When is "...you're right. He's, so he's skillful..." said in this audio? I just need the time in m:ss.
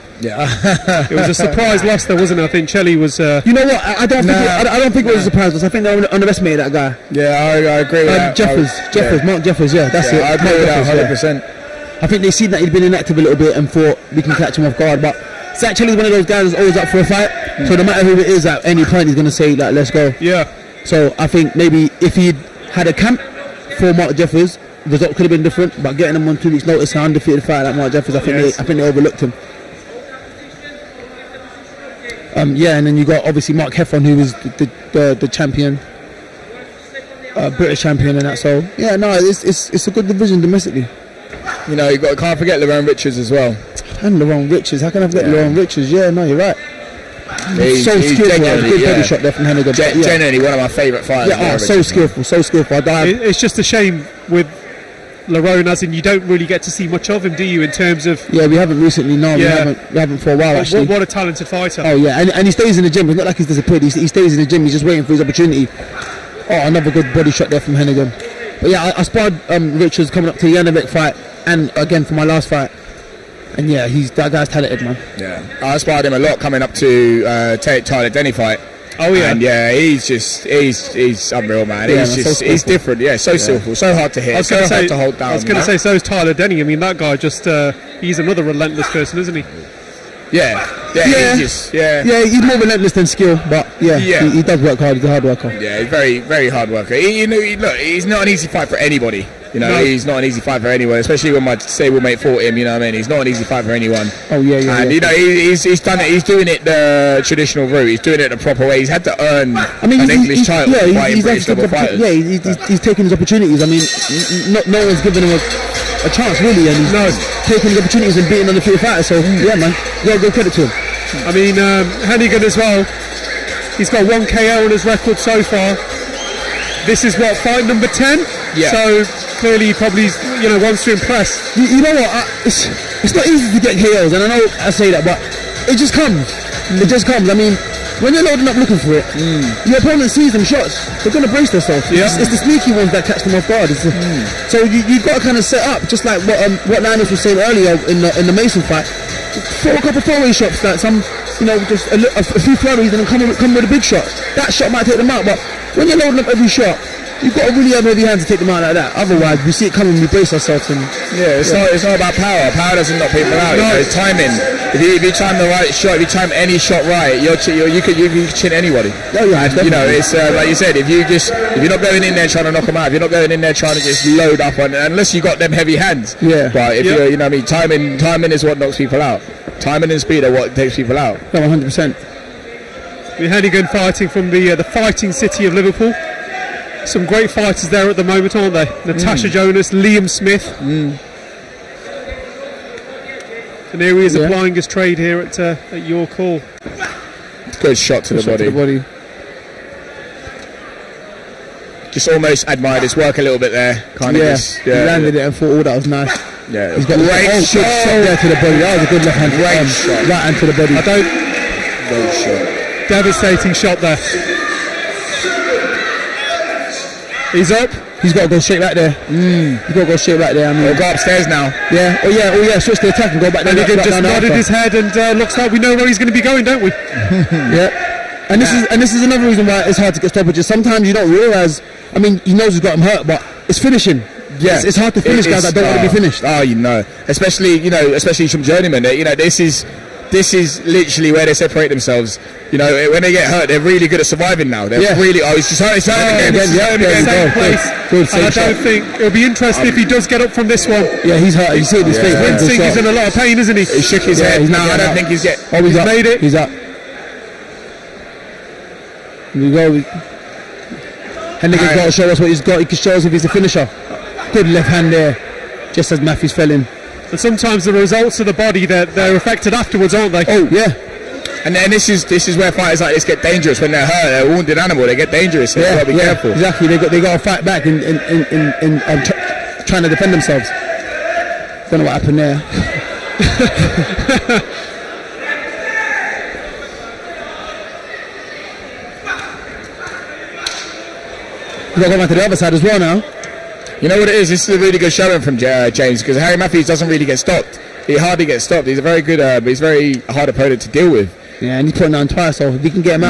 0:46.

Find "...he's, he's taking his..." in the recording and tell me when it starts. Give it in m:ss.
1:52.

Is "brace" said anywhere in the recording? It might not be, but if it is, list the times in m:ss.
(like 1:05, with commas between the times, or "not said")
2:21, 2:40.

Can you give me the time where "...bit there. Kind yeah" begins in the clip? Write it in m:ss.
3:23.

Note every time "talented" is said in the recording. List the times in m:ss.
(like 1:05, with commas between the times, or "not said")
1:01, 1:14.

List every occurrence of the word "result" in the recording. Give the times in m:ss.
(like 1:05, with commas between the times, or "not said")
0:24, 4:27.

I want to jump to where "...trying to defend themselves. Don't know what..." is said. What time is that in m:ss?
4:39.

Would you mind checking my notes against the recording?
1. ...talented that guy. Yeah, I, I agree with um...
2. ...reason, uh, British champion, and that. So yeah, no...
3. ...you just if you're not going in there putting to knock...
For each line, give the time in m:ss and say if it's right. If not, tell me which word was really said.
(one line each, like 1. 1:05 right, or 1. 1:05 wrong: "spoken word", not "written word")
1. 0:06 wrong: "underestimated", not "talented"
2. 0:35 wrong: "champion", not "reason"
3. 2:50 wrong: "trying", not "putting".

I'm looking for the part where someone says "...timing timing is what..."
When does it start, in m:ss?
2:57.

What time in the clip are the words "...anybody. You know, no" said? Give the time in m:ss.
1:38.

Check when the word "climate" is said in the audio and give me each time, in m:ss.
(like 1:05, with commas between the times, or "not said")
not said.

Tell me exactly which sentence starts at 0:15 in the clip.
But Zak Chelli's one of those guys that's always up for a fight.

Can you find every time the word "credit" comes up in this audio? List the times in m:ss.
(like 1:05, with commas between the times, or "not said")
2:00.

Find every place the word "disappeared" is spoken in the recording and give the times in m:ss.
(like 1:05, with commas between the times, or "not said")
1:03.